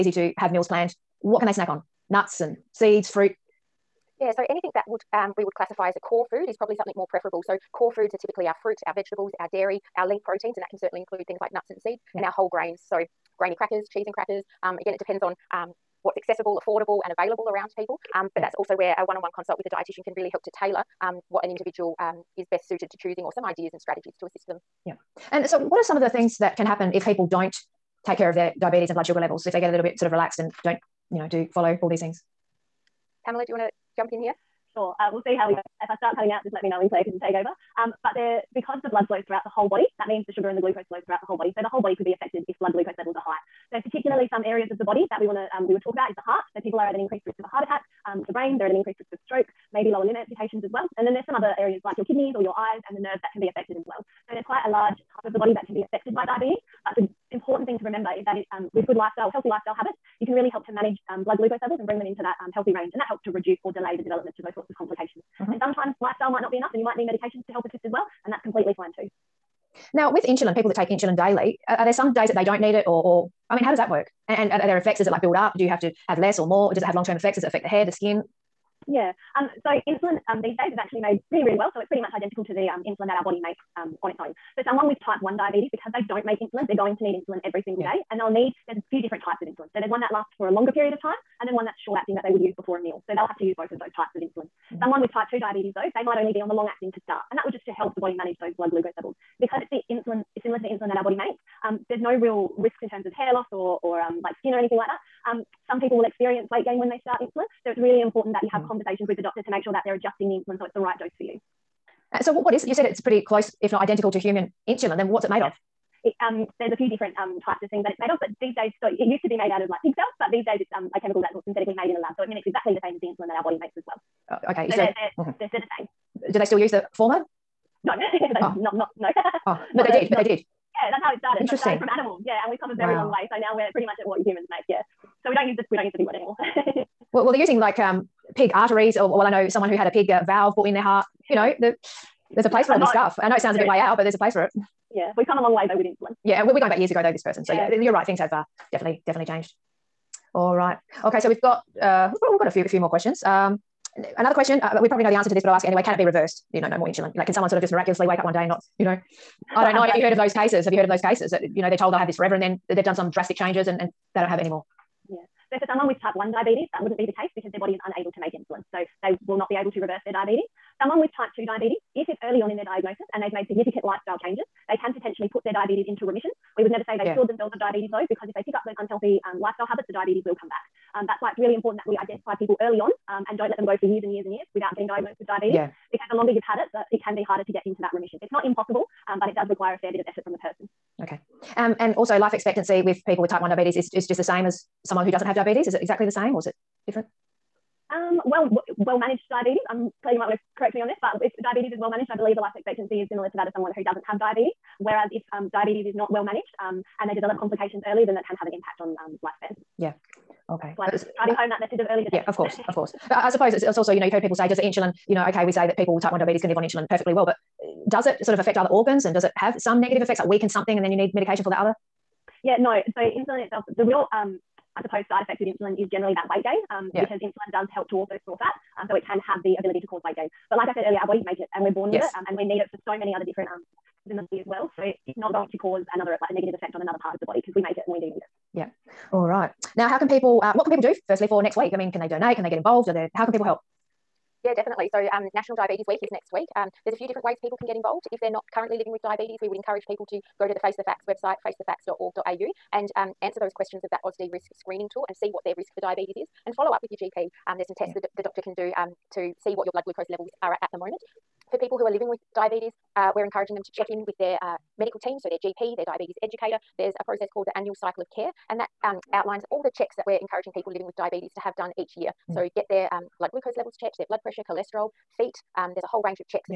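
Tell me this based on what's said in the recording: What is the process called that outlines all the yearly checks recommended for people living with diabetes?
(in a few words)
Annual cycle of care.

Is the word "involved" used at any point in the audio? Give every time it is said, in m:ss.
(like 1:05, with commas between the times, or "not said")
4:02, 4:07.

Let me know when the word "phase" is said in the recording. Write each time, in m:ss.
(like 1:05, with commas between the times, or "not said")
not said.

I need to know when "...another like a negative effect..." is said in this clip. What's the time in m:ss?
3:55.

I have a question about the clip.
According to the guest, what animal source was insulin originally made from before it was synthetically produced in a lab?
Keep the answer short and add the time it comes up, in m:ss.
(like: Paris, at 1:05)
Pig cells, at 1:59.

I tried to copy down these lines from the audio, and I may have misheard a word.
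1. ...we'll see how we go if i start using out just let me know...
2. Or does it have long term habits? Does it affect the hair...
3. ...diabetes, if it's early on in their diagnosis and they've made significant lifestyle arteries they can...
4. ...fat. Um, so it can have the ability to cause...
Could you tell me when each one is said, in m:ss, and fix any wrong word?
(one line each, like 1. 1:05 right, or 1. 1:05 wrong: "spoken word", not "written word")
1. 0:35 wrong: "cutting", not "using"
2. 1:16 wrong: "effects", not "habits"
3. 2:51 wrong: "changes", not "arteries"
4. 3:48 right.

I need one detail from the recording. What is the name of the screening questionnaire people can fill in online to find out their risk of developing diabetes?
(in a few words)
AUSDRISK.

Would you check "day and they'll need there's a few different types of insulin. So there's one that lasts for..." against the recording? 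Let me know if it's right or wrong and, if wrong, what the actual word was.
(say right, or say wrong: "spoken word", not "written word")
right.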